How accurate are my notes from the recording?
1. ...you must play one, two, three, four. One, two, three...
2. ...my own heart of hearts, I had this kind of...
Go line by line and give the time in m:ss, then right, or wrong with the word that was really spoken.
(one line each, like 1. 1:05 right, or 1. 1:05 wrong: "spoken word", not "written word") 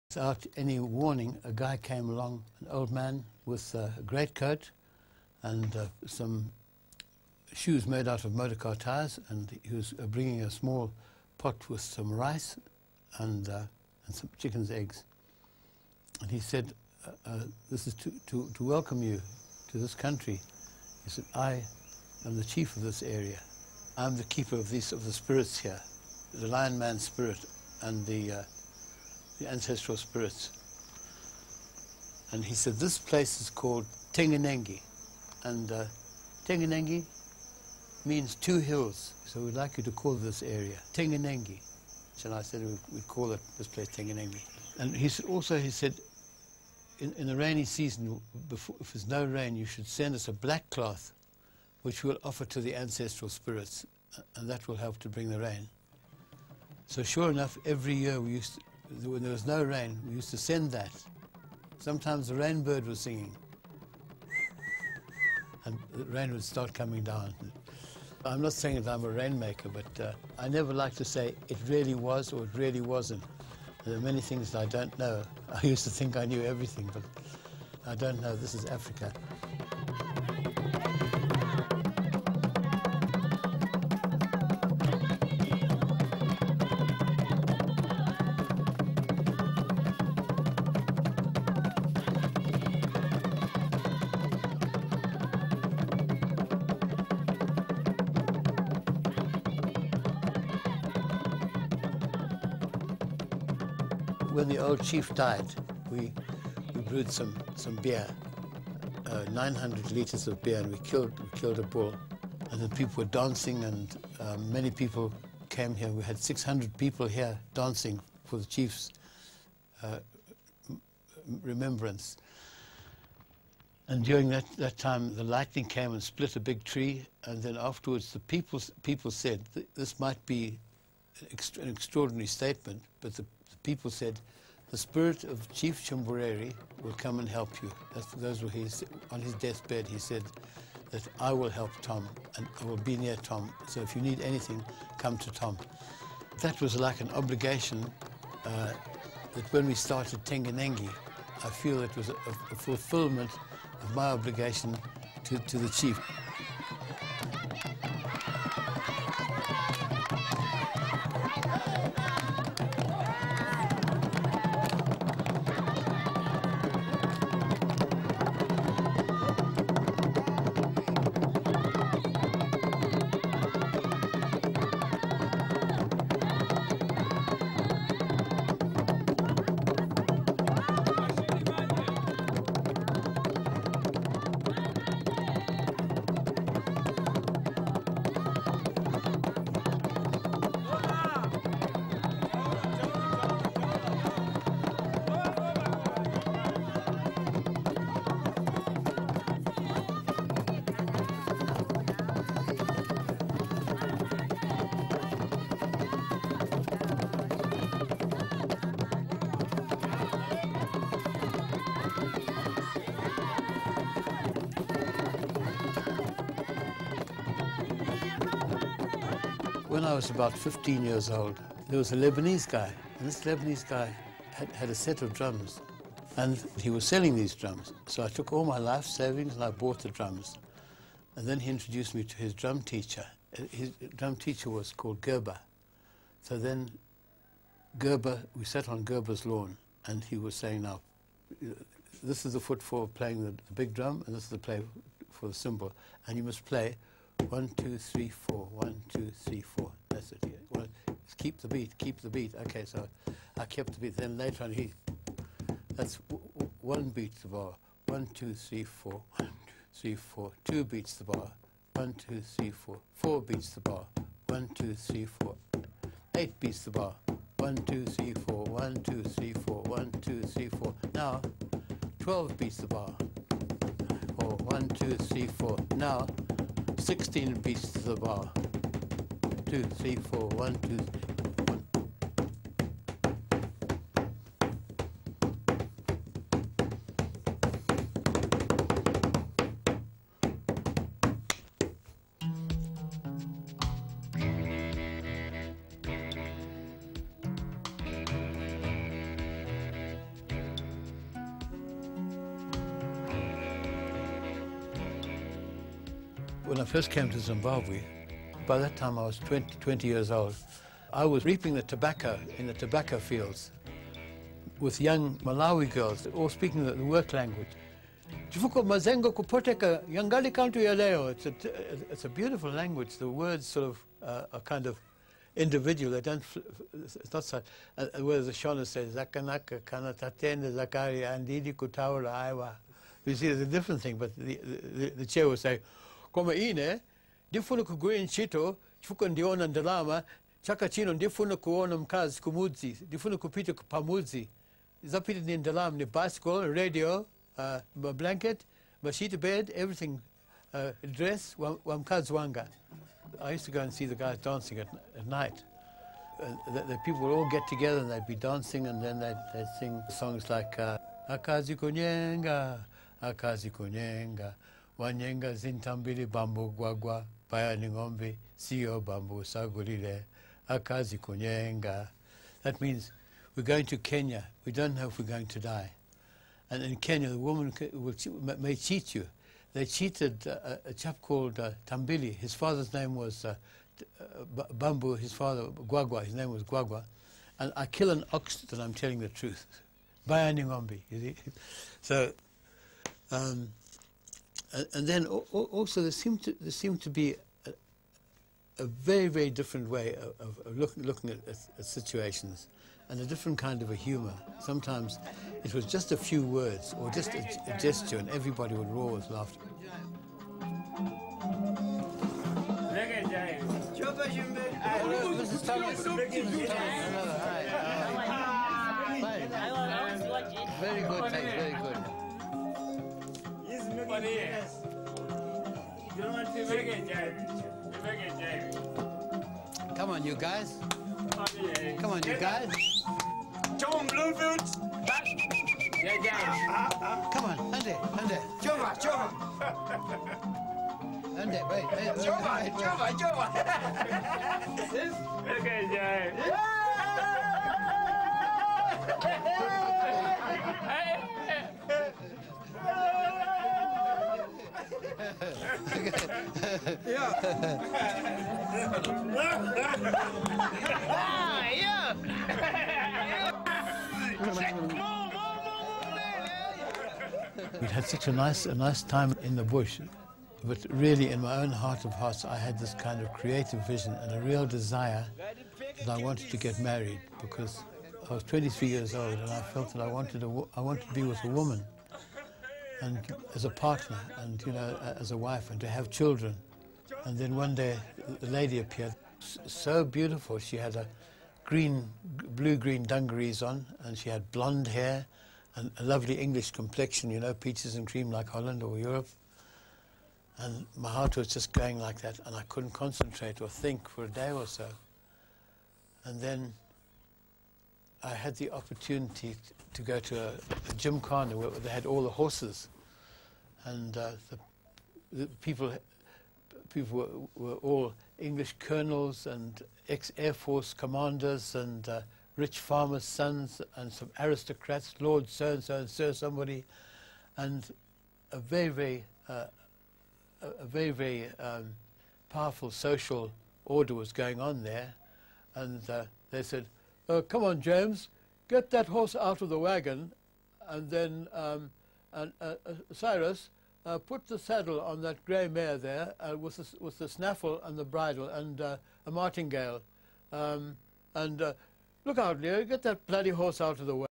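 1. 4:06 right
2. 7:51 right.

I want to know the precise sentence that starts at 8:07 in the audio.
And then one day, the lady appeared, so beautiful.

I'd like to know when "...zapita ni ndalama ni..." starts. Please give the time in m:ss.
5:44.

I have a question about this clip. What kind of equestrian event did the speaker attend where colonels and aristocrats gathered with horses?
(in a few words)
a gymkhana.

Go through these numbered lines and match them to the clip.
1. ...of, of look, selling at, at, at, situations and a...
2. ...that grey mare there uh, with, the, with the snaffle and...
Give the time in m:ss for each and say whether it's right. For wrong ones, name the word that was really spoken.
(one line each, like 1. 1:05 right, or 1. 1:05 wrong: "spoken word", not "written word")
1. 6:39 wrong: "looking", not "selling"
2. 9:05 right.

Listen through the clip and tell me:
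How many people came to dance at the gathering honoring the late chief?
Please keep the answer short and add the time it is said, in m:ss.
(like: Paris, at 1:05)
600, at 1:56.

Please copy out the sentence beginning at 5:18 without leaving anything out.
It's a, it's a beautiful language.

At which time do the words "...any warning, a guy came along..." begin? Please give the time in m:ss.
0:00.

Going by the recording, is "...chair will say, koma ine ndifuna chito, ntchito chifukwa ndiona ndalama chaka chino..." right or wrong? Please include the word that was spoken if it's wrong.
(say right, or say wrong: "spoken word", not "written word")
right.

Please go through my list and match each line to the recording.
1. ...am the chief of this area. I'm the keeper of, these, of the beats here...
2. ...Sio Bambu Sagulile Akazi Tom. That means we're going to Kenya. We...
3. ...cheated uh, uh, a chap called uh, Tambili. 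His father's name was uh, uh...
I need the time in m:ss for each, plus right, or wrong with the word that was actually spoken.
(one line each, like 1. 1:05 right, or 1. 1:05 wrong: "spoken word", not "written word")
1. 0:22 wrong: "spirits", not "beats"
2. 6:08 wrong: "Kunyenga", not "Tom"
3. 6:19 right.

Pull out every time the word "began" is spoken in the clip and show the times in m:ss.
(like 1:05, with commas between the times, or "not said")
not said.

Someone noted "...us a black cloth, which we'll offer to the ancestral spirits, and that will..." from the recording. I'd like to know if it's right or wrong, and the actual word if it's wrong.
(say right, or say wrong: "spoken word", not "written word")
right.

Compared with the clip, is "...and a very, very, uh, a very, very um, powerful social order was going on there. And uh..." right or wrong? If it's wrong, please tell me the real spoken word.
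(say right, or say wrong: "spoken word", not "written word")
right.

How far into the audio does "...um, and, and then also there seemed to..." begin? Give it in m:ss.
6:33.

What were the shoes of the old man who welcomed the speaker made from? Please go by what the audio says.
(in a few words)
motor car tires.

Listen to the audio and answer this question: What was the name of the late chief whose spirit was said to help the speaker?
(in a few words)
Chumbureri.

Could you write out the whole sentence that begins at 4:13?
Then later on, he, that's one beat the bar.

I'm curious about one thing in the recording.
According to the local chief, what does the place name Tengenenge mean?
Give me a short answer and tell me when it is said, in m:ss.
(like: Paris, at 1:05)
two hills, at 0:38.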